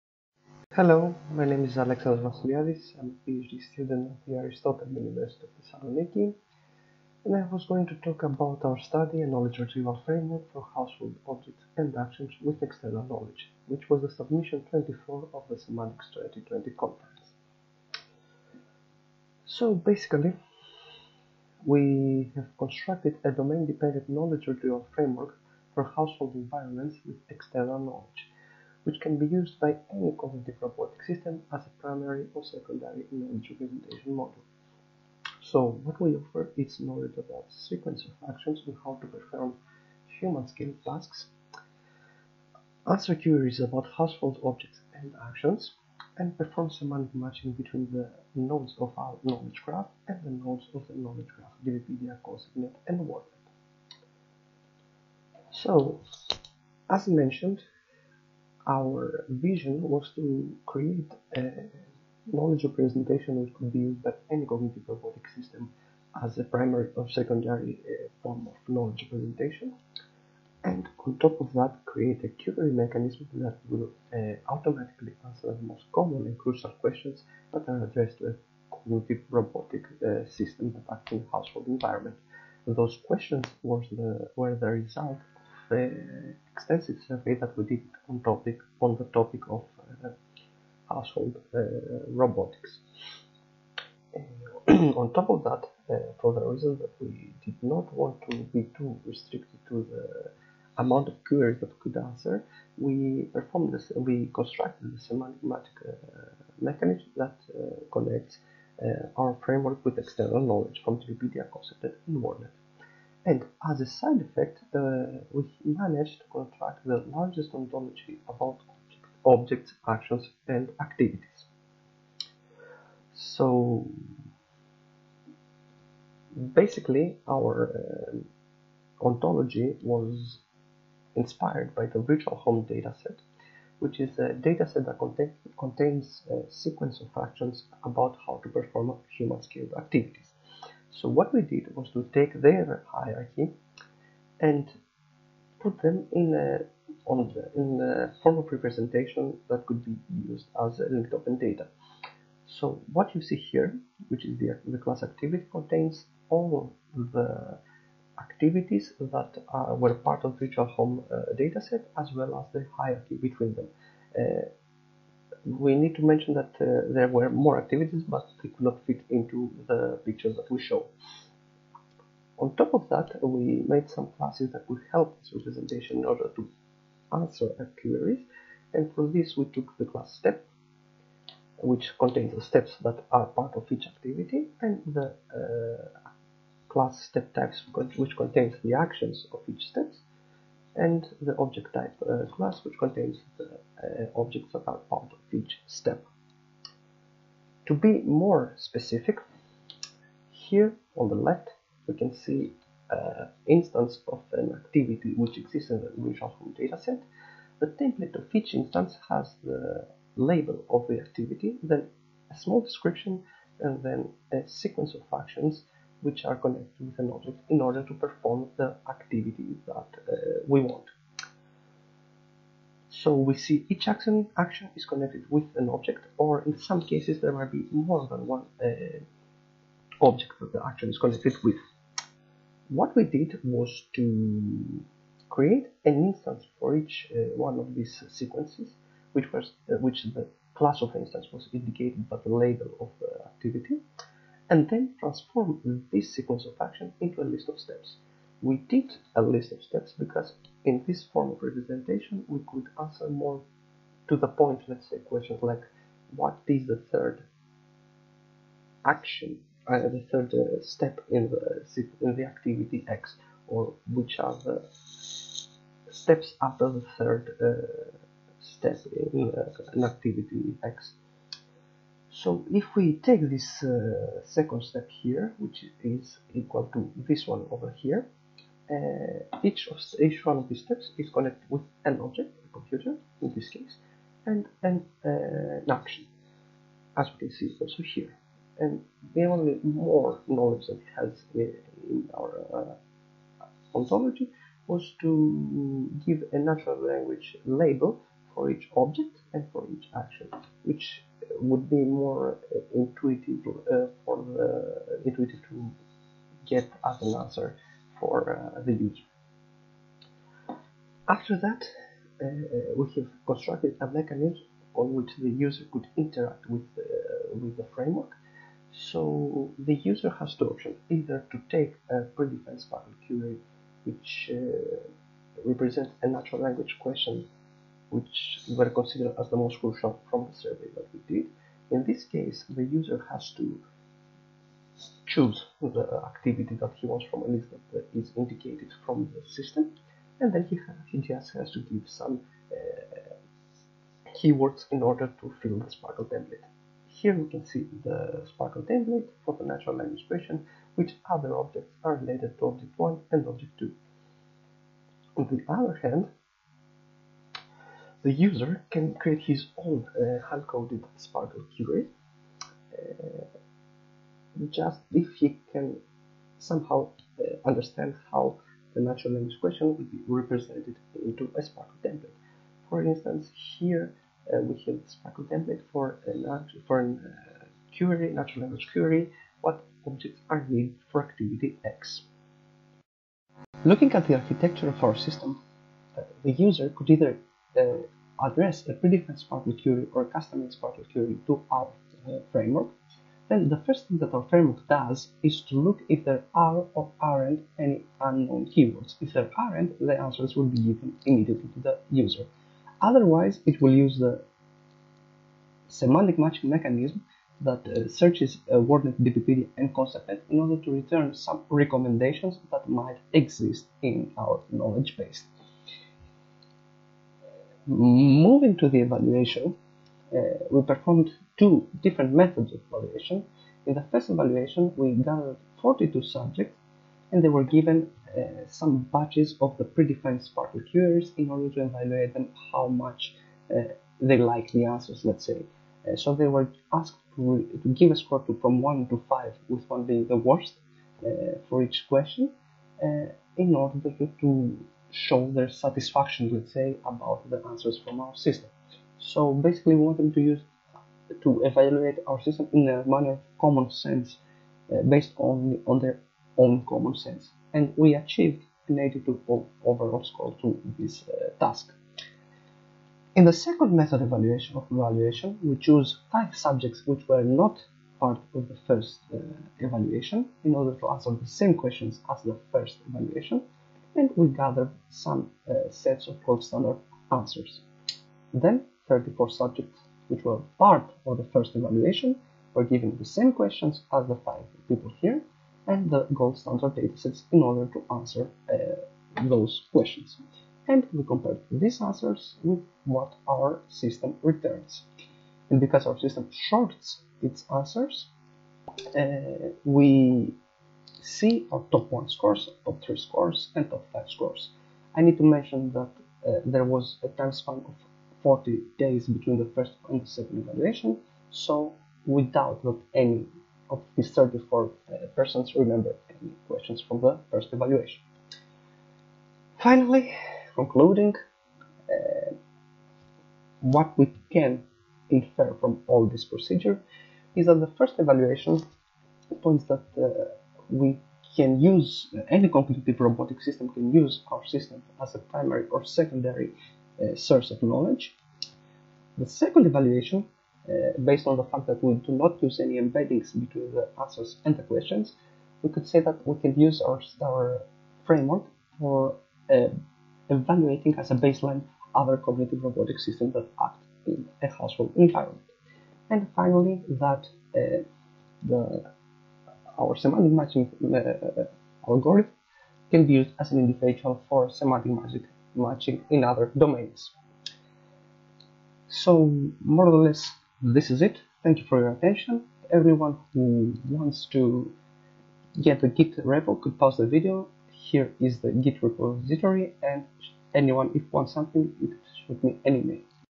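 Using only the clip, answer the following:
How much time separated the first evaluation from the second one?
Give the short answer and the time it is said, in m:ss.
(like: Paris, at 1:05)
40 days, at 8:28.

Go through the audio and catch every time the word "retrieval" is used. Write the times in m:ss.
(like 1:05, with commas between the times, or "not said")
0:09, 0:24.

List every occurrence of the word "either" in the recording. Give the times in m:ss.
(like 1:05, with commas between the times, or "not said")
5:20, 6:26.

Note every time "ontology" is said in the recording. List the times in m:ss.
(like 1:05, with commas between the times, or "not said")
1:57, 2:09, 4:53.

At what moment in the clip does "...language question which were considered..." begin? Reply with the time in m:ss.
5:26.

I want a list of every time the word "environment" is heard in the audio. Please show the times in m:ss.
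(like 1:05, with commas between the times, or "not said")
0:26, 1:21, 9:14.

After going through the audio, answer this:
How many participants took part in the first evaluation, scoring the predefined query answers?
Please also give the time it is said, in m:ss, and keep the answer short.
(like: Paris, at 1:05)
42, at 7:05.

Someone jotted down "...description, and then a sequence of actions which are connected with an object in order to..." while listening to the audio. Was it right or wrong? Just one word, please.
right.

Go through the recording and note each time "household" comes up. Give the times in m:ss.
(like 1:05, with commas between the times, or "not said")
0:10, 0:25, 0:43, 1:21, 1:30, 9:14.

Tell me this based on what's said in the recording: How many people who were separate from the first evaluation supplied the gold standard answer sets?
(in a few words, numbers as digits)
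5.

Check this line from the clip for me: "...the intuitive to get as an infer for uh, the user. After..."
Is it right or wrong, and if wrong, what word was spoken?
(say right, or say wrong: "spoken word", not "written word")
wrong: "answer", not "infer".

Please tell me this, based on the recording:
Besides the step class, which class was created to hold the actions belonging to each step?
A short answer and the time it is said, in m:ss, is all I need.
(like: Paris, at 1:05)
step types, at 3:06.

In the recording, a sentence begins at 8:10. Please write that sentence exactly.
And we compared these answers with what our system returns.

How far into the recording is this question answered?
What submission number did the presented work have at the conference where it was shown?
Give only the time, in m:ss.
0:14.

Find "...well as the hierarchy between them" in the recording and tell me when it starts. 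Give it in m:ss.
2:42.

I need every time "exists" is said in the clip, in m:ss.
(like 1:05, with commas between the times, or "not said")
3:25, 6:53.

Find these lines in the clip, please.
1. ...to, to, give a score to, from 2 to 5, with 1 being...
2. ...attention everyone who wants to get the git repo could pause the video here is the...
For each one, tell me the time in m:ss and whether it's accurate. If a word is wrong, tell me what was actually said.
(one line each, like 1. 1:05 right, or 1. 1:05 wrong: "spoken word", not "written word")
1. 7:17 wrong: "1", not "2"
2. 9:31 right.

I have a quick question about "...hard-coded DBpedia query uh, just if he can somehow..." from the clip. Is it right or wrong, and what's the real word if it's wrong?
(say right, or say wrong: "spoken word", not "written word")
wrong: "SPARQL", not "DBpedia".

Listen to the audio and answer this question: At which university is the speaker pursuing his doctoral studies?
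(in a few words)
Aristotle University of Thessaloniki.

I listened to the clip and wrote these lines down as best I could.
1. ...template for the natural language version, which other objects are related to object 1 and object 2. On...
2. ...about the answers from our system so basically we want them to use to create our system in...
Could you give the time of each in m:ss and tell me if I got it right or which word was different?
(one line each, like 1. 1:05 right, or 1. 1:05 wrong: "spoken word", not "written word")
1. 5:48 right
2. 7:26 wrong: "evaluate", not "create".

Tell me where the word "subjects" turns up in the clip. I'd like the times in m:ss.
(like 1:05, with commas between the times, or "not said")
7:06, 7:46, 7:59.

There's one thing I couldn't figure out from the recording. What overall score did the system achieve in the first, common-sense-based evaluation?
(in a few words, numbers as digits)
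82.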